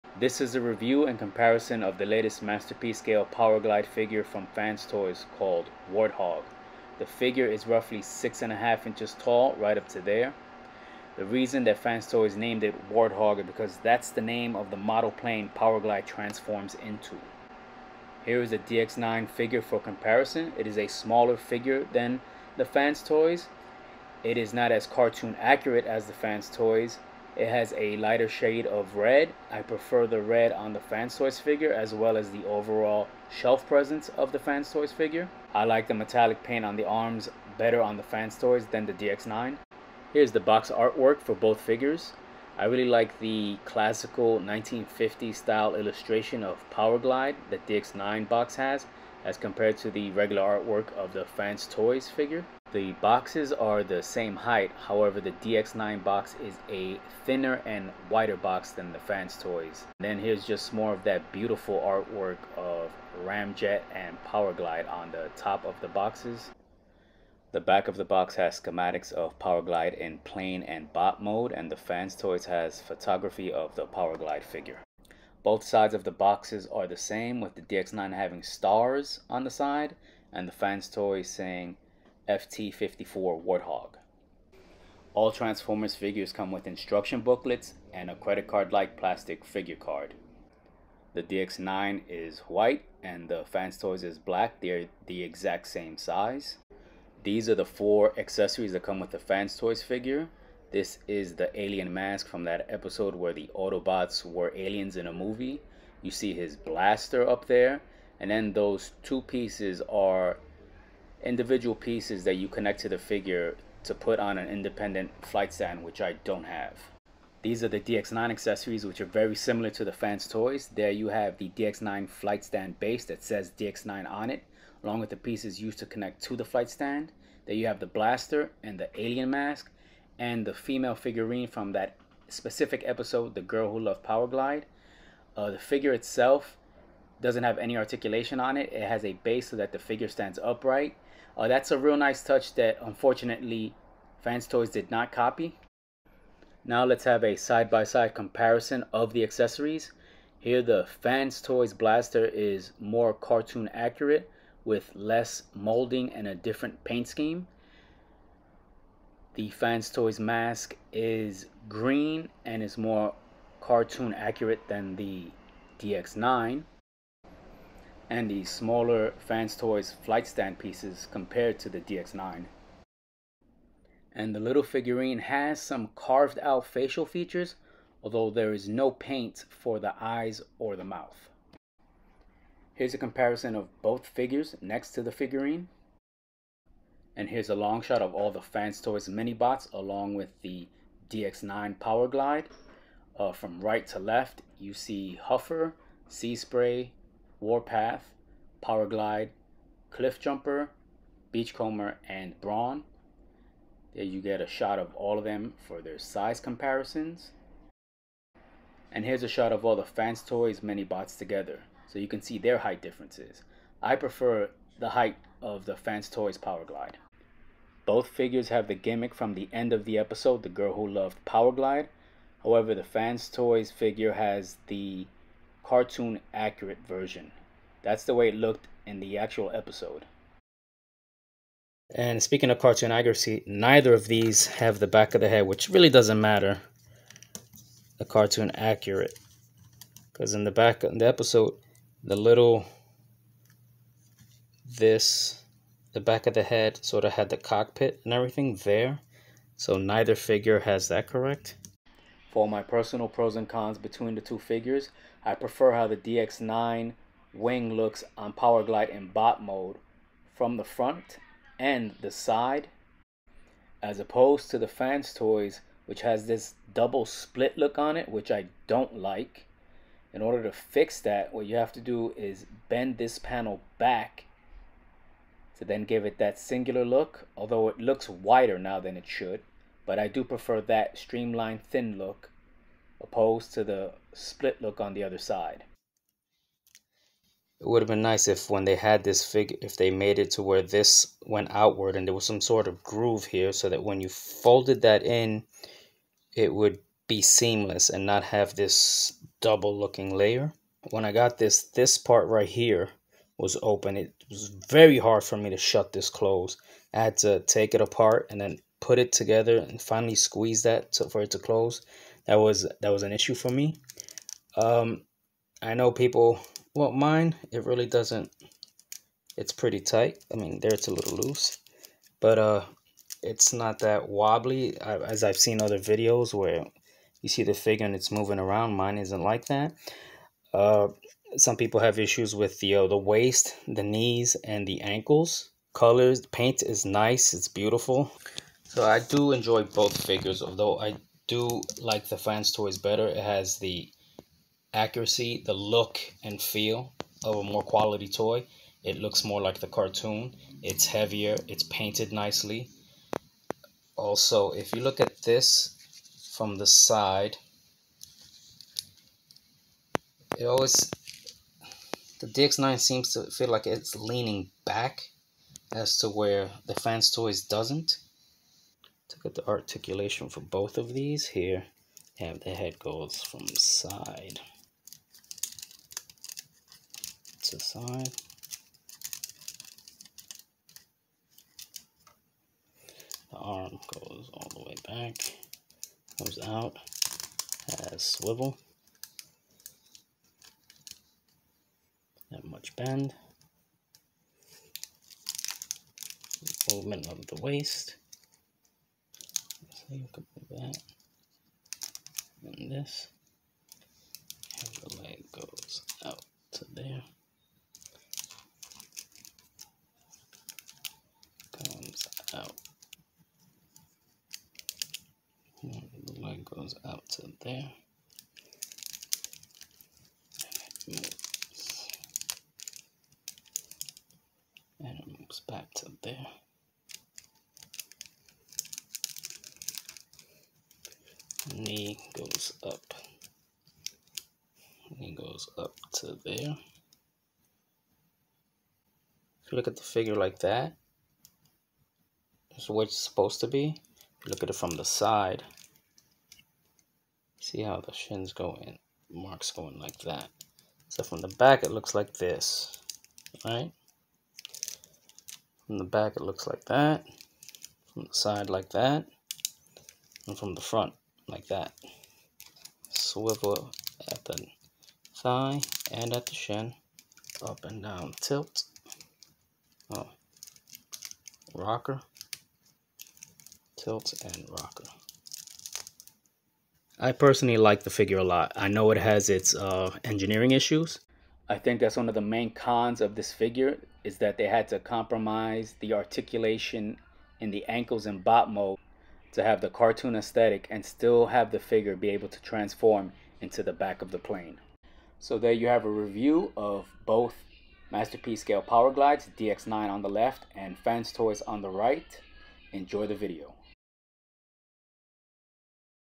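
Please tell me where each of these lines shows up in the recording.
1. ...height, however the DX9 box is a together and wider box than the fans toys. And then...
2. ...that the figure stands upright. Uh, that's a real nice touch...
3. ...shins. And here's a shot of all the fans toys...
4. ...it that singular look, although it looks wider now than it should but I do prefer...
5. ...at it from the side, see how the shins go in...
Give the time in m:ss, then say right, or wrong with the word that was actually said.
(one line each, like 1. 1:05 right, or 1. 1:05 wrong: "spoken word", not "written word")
1. 0:54 wrong: "thinner", not "together"
2. 2:19 right
3. 3:26 wrong: "comparisons", not "shins"
4. 4:36 right
5. 7:24 right.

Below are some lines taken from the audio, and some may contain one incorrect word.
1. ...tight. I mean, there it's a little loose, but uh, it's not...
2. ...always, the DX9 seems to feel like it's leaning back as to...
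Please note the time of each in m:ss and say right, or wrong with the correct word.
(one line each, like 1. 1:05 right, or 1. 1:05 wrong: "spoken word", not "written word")
1. 5:19 right
2. 6:00 right.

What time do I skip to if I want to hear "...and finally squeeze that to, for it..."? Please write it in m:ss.
5:09.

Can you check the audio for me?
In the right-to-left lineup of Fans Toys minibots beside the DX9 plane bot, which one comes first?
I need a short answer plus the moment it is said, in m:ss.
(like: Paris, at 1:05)
Huffer, at 3:15.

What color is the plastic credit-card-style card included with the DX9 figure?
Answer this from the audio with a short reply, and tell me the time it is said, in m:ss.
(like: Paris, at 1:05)
White, at 1:32.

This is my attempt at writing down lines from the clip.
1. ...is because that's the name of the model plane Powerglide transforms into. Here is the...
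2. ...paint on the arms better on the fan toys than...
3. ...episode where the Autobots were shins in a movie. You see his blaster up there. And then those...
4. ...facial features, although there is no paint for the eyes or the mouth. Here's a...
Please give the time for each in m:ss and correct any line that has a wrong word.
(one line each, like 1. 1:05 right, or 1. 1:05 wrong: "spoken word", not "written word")
1. 0:13 right
2. 0:36 right
3. 1:42 wrong: "aliens", not "shins"
4. 2:56 right.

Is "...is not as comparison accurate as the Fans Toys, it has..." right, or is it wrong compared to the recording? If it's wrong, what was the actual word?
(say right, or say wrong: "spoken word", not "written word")
wrong: "cartoon", not "comparison".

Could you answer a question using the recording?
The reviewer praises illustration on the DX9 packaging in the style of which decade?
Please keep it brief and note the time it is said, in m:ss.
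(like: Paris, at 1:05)
1950, at 0:44.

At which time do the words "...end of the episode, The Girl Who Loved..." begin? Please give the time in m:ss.
3:39.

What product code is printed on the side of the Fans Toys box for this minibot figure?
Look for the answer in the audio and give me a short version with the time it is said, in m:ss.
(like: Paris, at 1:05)
FT-54, at 1:22.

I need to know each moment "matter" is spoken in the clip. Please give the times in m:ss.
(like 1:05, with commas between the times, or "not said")
3:56.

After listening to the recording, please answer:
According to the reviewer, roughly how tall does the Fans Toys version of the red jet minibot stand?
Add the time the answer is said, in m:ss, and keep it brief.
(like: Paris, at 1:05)
6.5 inches, at 0:08.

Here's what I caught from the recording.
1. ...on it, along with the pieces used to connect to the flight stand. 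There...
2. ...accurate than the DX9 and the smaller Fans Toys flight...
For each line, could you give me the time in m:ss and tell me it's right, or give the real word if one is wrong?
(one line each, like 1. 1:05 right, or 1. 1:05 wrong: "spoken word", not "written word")
1. 2:04 right
2. 2:44 right.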